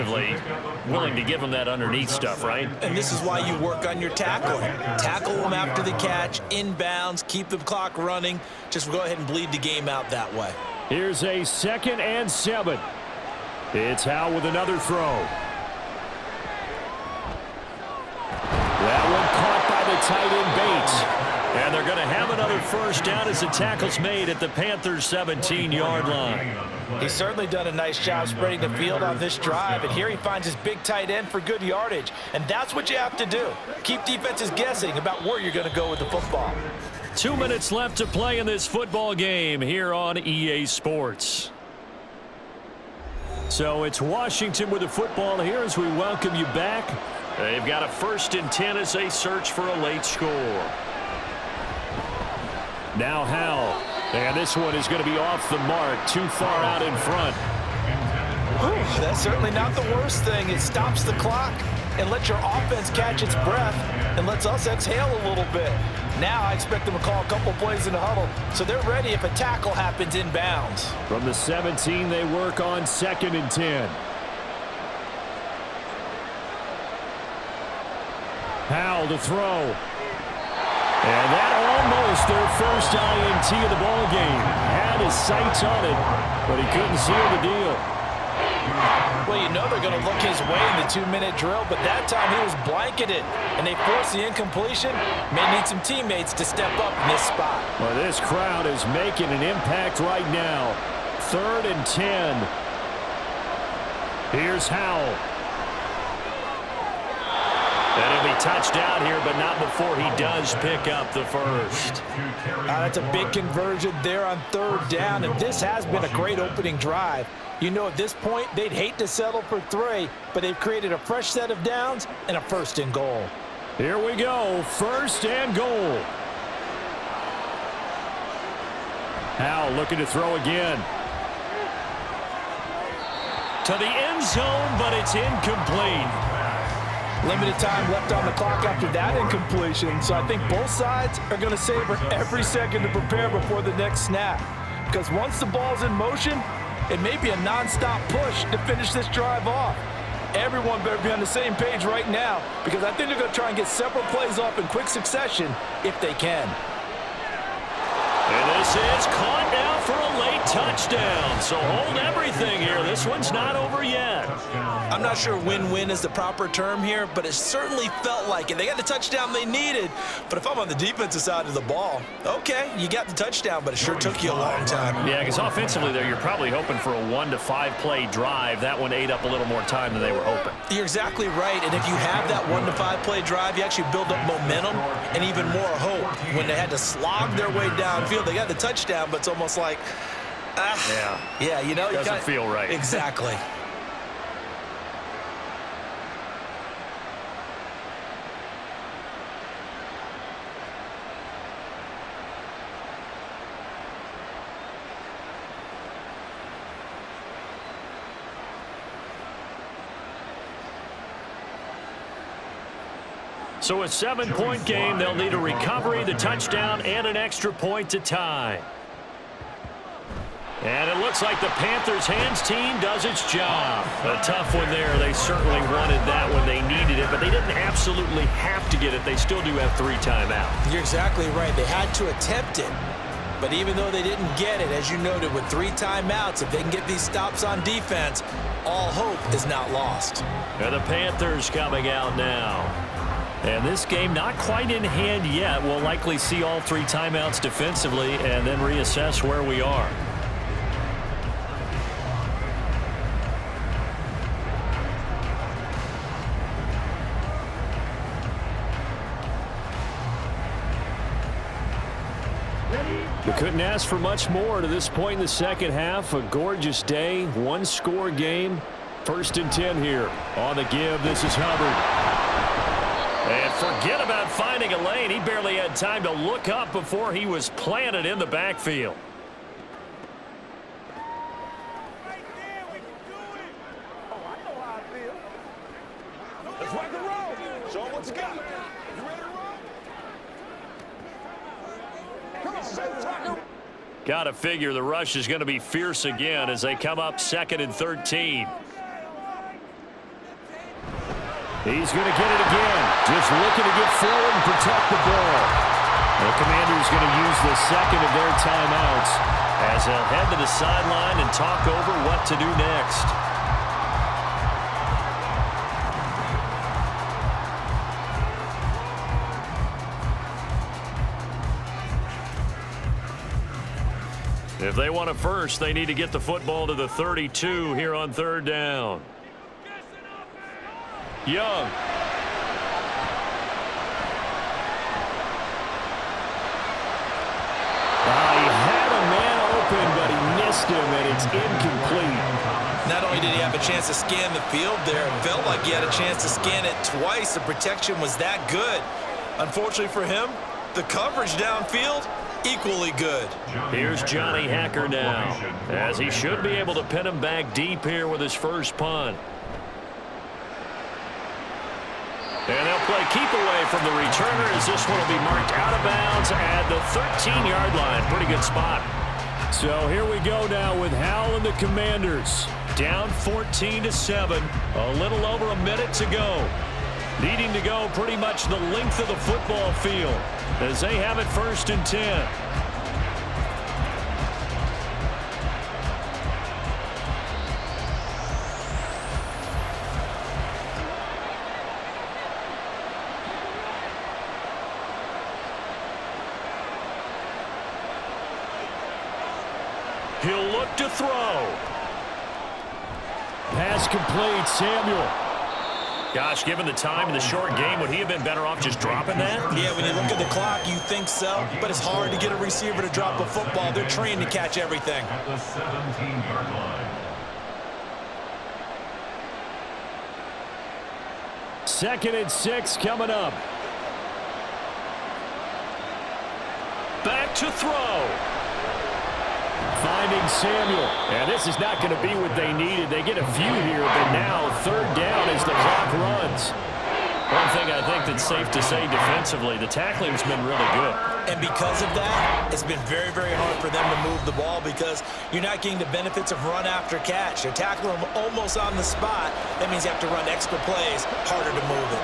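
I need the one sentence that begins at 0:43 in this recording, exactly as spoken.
So it's Washington with the football here as we welcome you back.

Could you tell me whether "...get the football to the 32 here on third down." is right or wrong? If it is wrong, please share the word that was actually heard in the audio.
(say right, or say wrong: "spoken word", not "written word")
right.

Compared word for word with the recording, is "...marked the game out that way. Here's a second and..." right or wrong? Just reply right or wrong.
wrong.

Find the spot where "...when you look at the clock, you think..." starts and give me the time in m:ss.
6:49.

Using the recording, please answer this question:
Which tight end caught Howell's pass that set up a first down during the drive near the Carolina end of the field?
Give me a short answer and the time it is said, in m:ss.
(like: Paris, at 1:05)
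Bates, at 0:20.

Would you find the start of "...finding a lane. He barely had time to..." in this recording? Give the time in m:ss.
4:34.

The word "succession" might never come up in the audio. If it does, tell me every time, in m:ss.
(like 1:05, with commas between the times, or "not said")
2:34.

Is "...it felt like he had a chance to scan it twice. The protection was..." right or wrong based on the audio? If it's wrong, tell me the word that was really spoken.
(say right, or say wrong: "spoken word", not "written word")
right.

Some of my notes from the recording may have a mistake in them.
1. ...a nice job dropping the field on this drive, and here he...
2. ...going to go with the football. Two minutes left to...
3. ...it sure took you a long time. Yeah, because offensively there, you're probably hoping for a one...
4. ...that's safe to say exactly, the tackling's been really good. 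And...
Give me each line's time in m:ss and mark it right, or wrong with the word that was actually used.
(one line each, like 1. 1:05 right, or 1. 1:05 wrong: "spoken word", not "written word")
1. 0:27 wrong: "spreading", not "dropping"
2. 0:35 right
3. 2:53 right
4. 7:18 wrong: "defensively", not "exactly".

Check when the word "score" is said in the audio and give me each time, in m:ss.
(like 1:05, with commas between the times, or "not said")
0:50, 4:27.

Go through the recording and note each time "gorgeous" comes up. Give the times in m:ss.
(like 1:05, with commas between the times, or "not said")
4:26.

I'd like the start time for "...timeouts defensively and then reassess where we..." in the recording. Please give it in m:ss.
4:06.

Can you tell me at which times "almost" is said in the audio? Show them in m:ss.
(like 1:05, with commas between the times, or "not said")
1:21, 3:09, 7:28.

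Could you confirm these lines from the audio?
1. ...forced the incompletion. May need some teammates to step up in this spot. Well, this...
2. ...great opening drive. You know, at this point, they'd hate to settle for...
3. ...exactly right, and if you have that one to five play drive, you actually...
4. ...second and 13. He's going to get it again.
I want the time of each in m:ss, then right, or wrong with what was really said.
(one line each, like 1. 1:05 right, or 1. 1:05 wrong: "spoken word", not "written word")
1. 1:33 right
2. 1:56 right
3. 3:00 right
4. 4:57 right.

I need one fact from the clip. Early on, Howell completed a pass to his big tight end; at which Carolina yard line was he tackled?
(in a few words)
17.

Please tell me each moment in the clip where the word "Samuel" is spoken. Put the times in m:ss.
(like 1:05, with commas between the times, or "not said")
6:44, 7:10.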